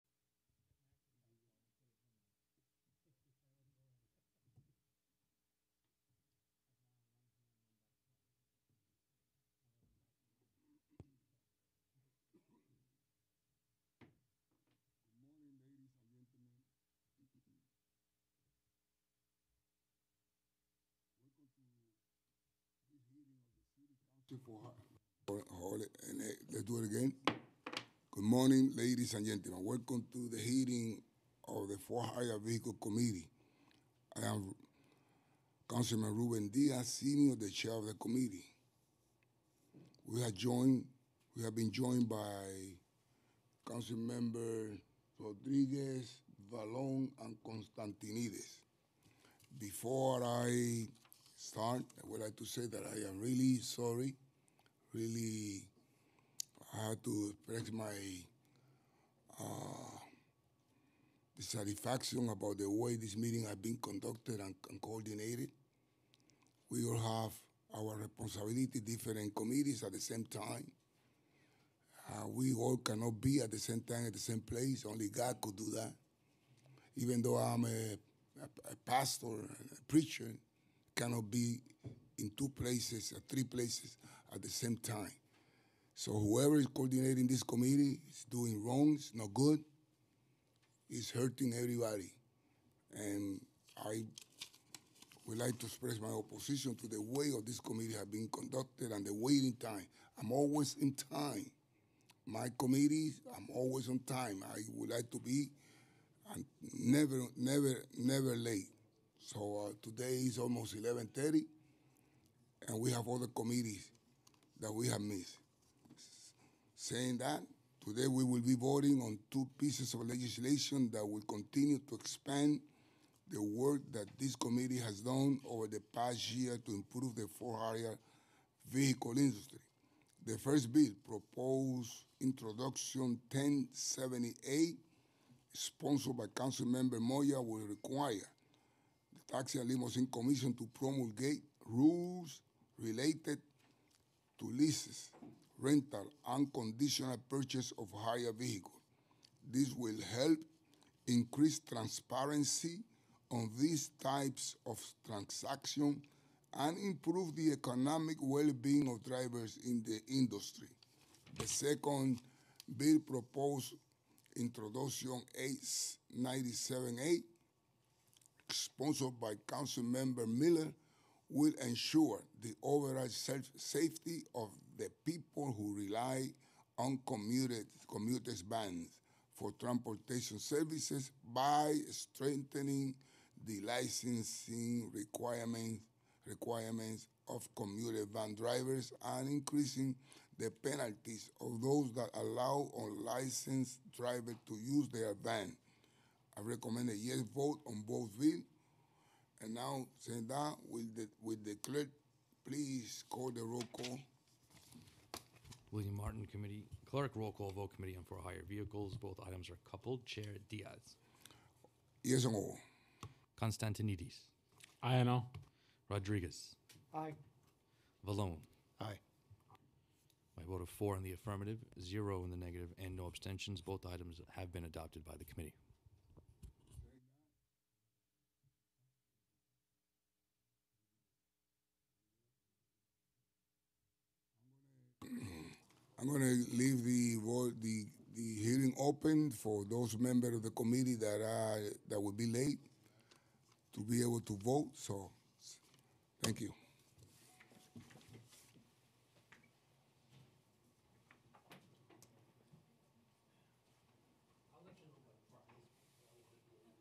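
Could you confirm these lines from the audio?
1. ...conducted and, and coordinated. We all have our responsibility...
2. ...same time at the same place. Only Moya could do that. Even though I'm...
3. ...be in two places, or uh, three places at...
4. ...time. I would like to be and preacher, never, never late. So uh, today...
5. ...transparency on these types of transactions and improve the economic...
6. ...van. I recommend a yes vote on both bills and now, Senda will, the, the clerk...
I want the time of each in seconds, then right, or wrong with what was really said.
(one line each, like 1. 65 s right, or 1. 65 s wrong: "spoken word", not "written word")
1. 63 s right
2. 73 s wrong: "God", not "Moya"
3. 81 s right
4. 103 s wrong: "never", not "preacher"
5. 151 s right
6. 195 s right.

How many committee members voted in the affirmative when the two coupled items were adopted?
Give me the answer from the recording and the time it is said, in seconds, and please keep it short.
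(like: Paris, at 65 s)
4, at 220 s.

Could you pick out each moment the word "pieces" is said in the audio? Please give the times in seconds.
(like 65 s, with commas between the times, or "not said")
119 s.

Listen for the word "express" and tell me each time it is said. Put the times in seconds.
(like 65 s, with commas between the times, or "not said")
57 s, 95 s.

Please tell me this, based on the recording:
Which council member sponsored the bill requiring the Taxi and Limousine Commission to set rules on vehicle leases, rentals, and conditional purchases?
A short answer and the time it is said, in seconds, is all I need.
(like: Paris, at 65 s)
Moya, at 136 s.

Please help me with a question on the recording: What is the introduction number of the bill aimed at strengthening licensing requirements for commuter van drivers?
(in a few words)
897 a.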